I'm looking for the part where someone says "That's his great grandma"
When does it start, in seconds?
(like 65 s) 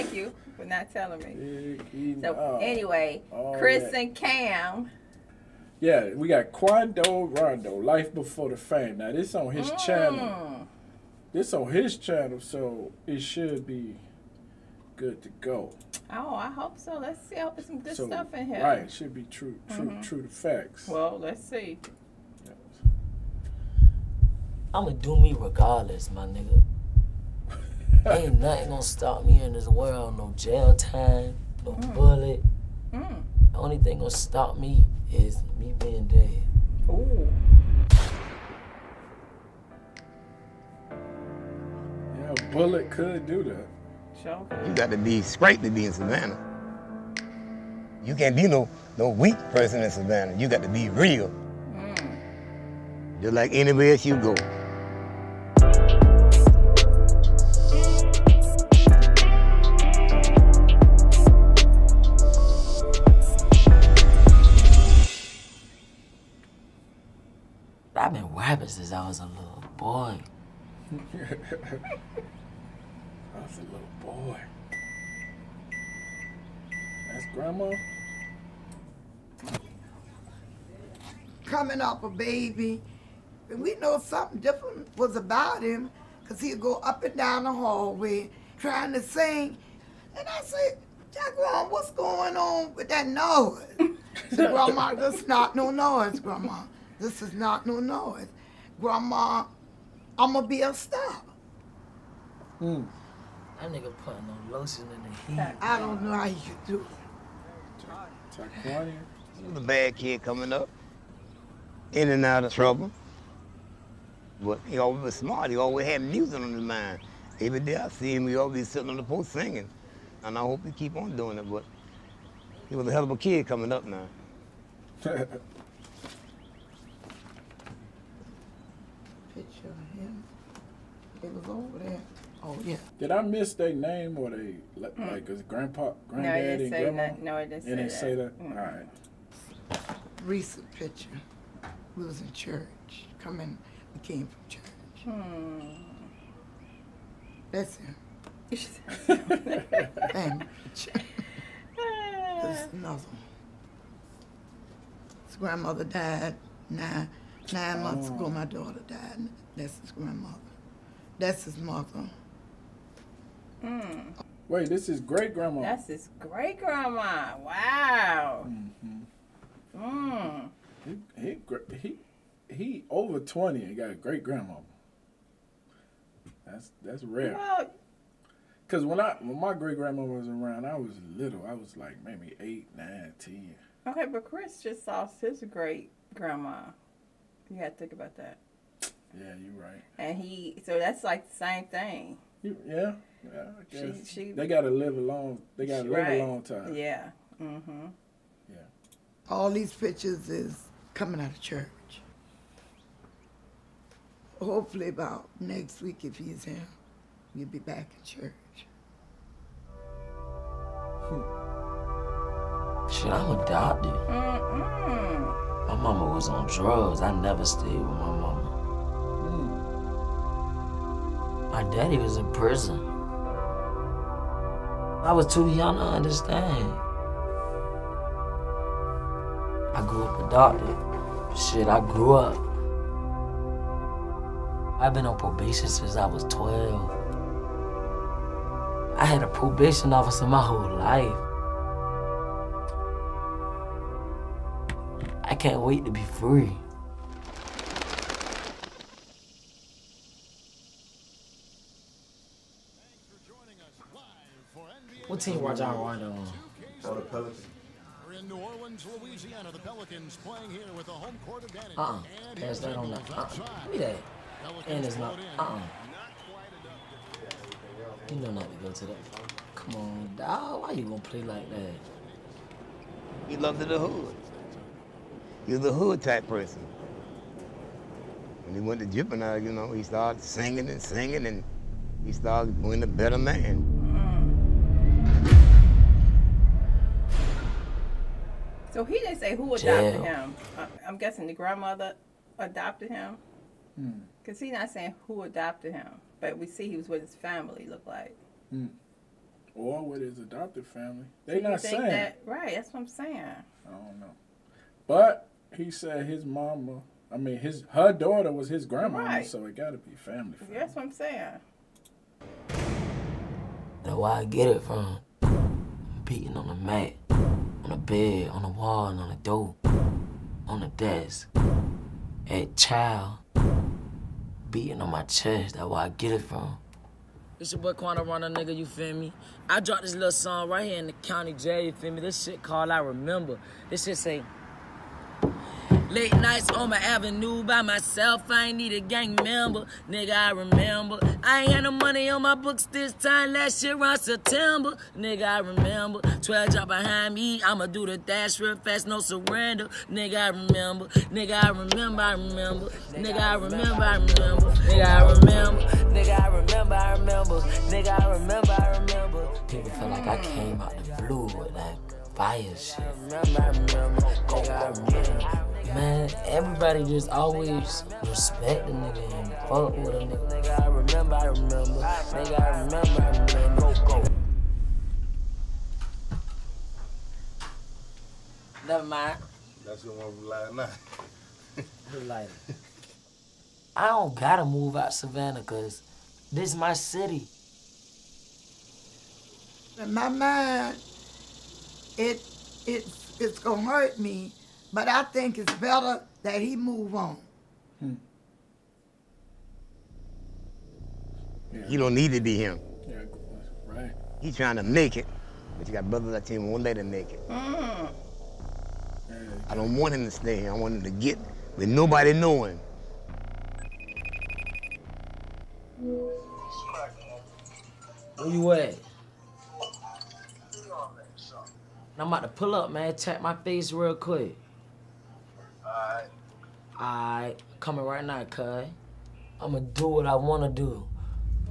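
165 s.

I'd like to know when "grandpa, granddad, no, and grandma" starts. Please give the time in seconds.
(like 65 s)
135 s.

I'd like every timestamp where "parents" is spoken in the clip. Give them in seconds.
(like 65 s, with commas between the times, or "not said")
not said.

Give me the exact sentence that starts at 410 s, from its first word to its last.
I want him to get with nobody knowing.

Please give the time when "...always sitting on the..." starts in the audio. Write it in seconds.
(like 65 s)
118 s.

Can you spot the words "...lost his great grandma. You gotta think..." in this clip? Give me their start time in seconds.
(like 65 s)
184 s.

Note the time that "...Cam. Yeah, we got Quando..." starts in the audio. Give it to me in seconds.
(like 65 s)
4 s.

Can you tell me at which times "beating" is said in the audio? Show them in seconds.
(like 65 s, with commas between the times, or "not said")
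316 s, 324 s.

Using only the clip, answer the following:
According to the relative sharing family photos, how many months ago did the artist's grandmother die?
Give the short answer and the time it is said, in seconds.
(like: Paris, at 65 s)
9, at 157 s.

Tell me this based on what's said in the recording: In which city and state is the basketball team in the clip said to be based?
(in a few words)
New Orleans, Louisiana.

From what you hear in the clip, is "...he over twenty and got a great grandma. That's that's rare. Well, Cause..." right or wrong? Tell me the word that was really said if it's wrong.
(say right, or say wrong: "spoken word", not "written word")
right.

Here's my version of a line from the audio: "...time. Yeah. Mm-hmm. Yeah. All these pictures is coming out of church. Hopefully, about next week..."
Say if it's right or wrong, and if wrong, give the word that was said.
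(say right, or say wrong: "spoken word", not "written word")
right.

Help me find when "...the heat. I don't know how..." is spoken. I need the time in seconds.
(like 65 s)
105 s.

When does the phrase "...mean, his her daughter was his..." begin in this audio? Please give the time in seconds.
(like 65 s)
307 s.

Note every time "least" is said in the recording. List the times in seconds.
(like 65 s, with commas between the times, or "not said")
not said.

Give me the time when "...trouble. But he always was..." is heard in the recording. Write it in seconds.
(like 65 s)
112 s.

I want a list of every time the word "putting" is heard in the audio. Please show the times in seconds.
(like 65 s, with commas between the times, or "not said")
104 s.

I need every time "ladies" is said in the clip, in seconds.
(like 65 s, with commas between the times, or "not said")
not said.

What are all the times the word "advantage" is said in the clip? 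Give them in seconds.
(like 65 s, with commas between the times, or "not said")
261 s.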